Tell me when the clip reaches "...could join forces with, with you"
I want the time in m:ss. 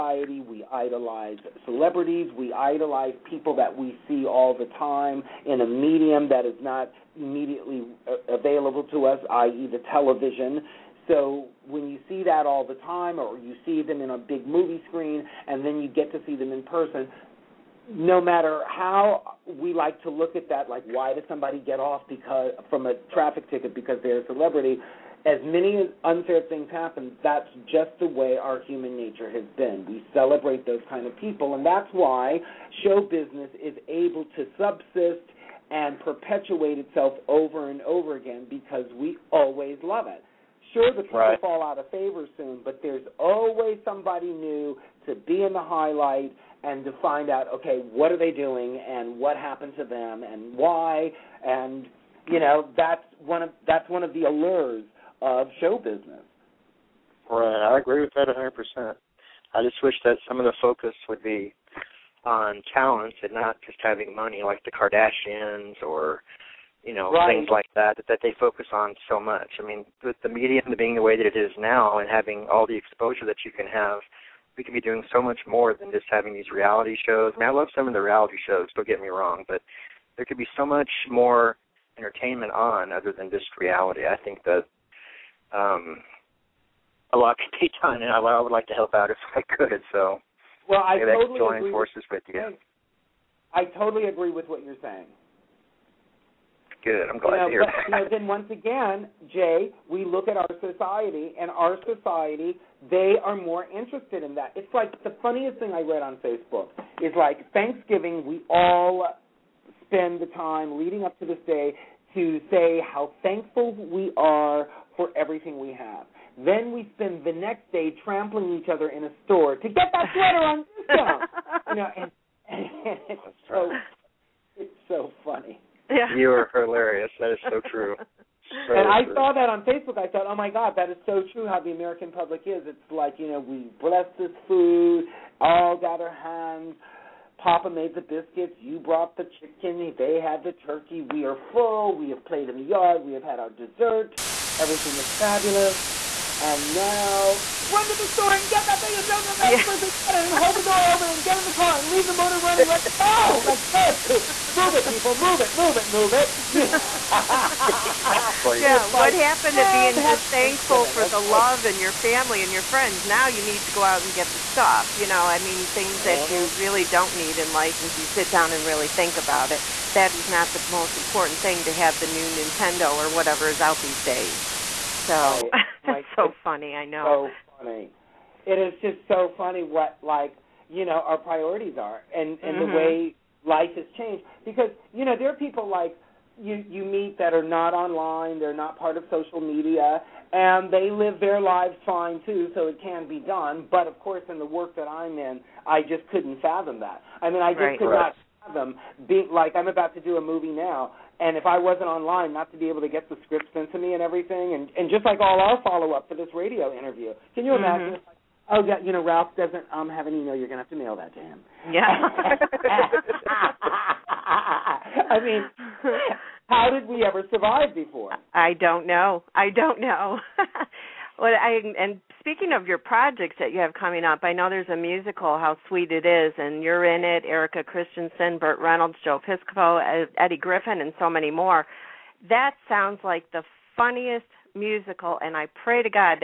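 1:31.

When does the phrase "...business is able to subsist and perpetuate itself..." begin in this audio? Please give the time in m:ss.
0:33.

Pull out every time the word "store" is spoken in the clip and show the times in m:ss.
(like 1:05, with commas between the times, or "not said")
1:59, 2:28.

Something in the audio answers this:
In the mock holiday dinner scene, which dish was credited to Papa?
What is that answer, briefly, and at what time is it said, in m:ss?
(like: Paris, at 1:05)
The biscuits, at 2:18.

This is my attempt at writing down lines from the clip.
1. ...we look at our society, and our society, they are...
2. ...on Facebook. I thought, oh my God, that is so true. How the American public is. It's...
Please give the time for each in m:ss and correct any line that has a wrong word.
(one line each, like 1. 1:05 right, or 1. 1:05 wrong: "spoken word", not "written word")
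1. 1:39 right
2. 2:09 right.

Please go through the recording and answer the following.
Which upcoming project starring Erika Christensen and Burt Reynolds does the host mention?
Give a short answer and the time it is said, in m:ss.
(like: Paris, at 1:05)
How Sweet It Is, at 3:45.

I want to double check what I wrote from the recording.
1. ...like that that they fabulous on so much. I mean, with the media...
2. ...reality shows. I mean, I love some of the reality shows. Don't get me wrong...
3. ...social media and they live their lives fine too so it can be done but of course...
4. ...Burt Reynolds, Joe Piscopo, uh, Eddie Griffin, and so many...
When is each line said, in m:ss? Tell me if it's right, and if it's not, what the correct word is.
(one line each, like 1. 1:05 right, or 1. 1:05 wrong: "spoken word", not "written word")
1. 1:07 wrong: "focus", not "fabulous"
2. 1:16 right
3. 3:09 right
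4. 3:48 right.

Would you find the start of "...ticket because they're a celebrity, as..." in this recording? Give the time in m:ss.
0:23.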